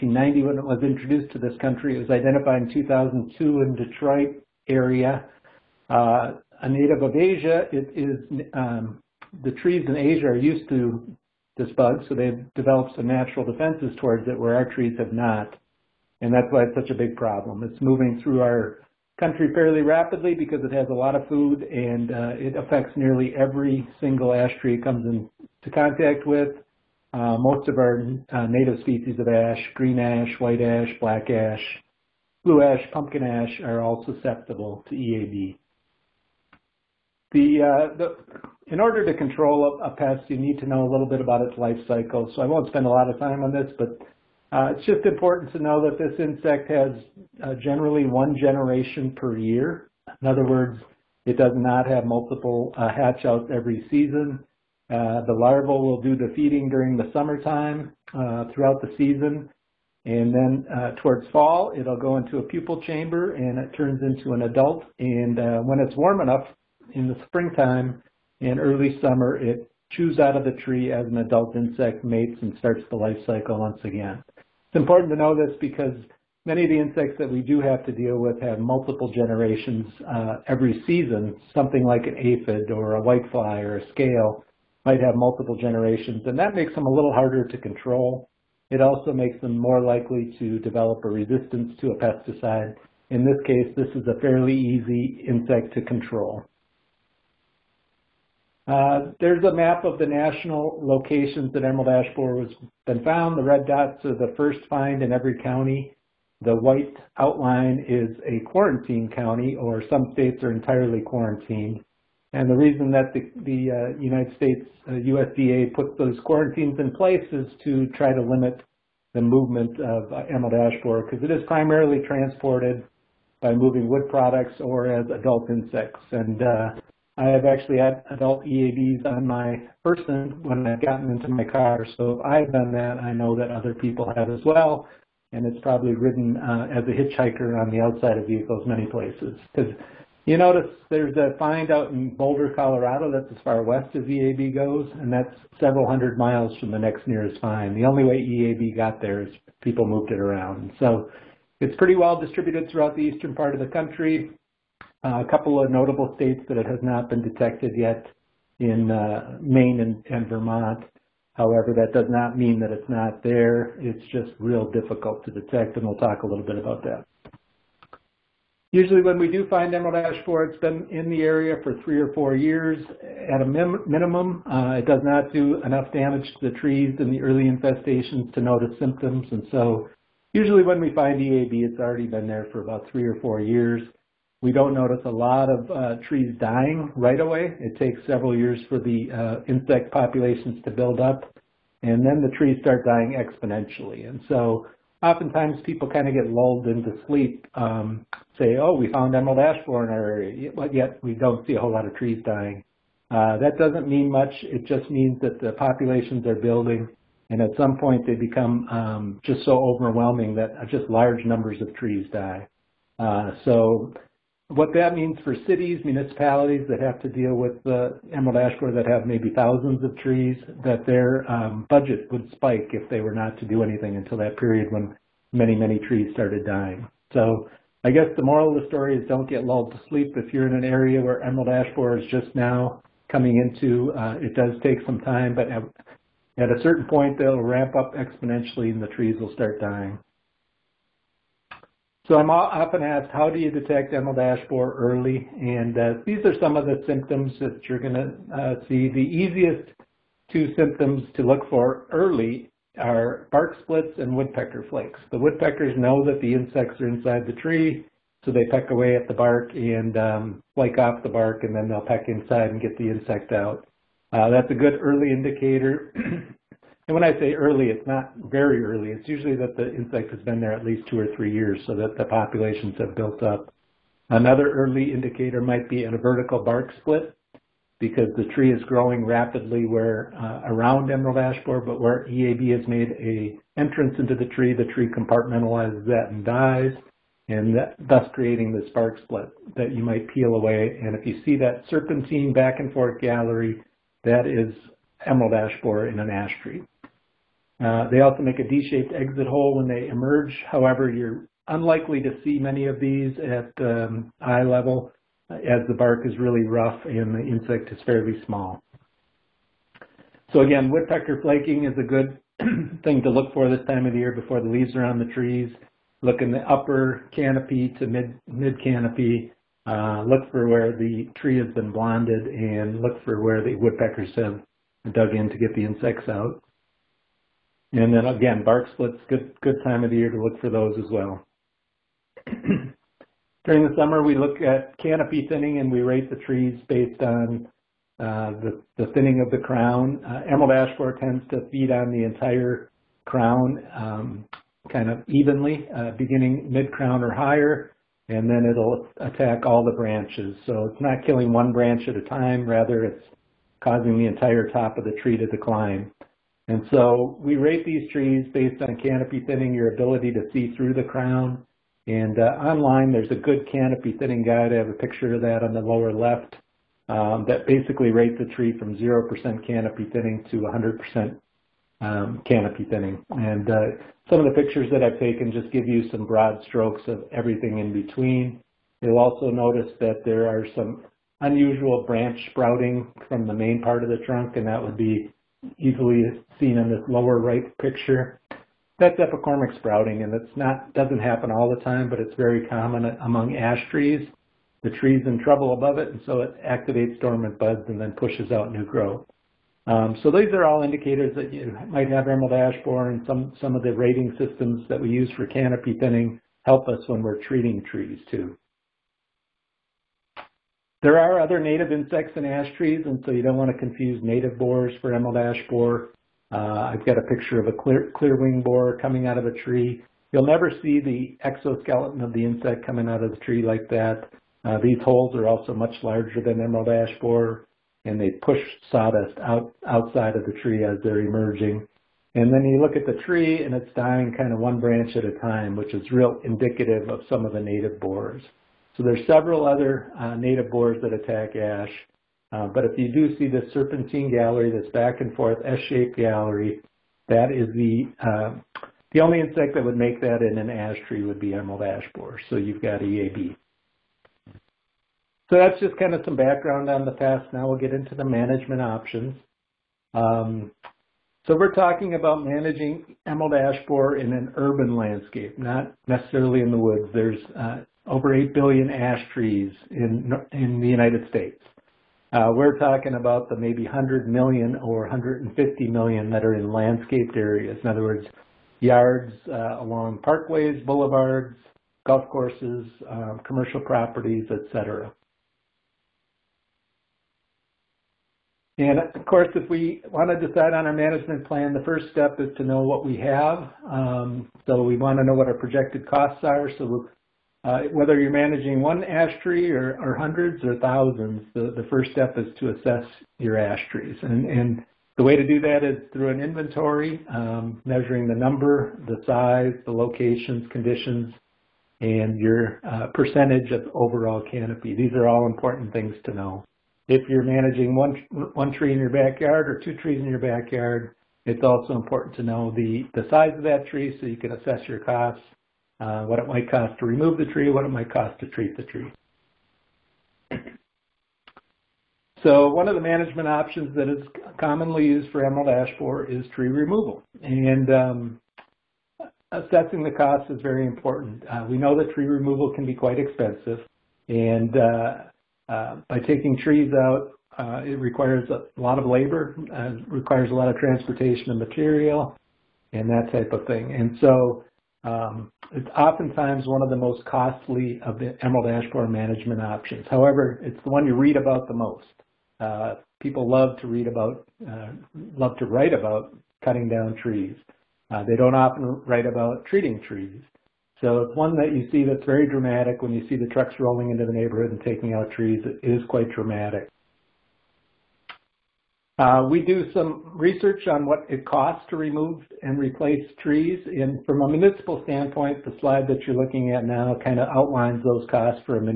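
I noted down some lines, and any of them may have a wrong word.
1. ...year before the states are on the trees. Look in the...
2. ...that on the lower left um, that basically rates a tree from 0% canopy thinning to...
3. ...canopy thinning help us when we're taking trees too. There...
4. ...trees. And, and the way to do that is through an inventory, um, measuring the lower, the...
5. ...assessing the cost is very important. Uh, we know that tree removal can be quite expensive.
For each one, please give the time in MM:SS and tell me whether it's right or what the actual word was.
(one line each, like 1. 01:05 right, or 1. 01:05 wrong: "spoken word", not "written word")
1. 05:13 wrong: "leaves", not "states"
2. 06:05 right
3. 06:45 wrong: "treating", not "taking"
4. 08:23 wrong: "number", not "lower"
5. 08:59 right.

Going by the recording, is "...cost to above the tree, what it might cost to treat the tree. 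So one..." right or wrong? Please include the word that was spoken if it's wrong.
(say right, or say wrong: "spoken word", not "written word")
wrong: "remove", not "above".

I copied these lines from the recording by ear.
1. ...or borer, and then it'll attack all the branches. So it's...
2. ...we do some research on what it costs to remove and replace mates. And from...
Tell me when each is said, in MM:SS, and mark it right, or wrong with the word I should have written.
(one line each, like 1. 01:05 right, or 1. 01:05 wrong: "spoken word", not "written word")
1. 05:47 wrong: "higher", not "borer"
2. 09:39 wrong: "trees", not "mates".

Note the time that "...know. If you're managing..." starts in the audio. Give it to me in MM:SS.
08:36.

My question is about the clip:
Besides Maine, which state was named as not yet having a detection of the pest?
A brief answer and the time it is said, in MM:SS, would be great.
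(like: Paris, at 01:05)
Vermont, at 02:40.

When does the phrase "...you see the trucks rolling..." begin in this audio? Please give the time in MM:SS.
09:32.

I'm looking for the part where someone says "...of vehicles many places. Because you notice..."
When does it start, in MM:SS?
02:18.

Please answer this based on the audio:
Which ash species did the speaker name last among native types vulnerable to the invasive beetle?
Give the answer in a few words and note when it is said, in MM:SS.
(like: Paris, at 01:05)
pumpkin ash, at 00:32.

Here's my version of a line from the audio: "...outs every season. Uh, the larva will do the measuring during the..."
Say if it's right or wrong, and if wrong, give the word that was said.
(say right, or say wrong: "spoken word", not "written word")
wrong: "feeding", not "measuring".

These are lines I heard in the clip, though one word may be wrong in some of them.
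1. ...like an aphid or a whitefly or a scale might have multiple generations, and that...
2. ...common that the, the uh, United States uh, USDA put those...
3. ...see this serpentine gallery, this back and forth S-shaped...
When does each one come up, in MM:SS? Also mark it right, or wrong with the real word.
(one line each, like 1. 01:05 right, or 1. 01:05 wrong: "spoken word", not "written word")
1. 01:21 right
2. 01:52 wrong: "reason", not "common"
3. 07:23 right.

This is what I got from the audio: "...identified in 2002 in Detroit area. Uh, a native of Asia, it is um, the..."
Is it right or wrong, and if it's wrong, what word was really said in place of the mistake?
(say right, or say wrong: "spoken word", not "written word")
right.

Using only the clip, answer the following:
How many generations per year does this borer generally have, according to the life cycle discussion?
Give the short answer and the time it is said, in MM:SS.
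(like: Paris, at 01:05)
1, at 00:48.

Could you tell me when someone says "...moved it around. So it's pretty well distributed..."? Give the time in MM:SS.
02:29.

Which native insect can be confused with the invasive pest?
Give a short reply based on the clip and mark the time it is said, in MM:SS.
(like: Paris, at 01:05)
clear wing borer, at 06:57.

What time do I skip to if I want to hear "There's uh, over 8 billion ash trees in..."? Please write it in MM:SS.
07:46.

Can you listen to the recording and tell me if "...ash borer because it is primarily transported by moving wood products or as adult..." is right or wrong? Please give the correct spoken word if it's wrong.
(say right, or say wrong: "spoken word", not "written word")
right.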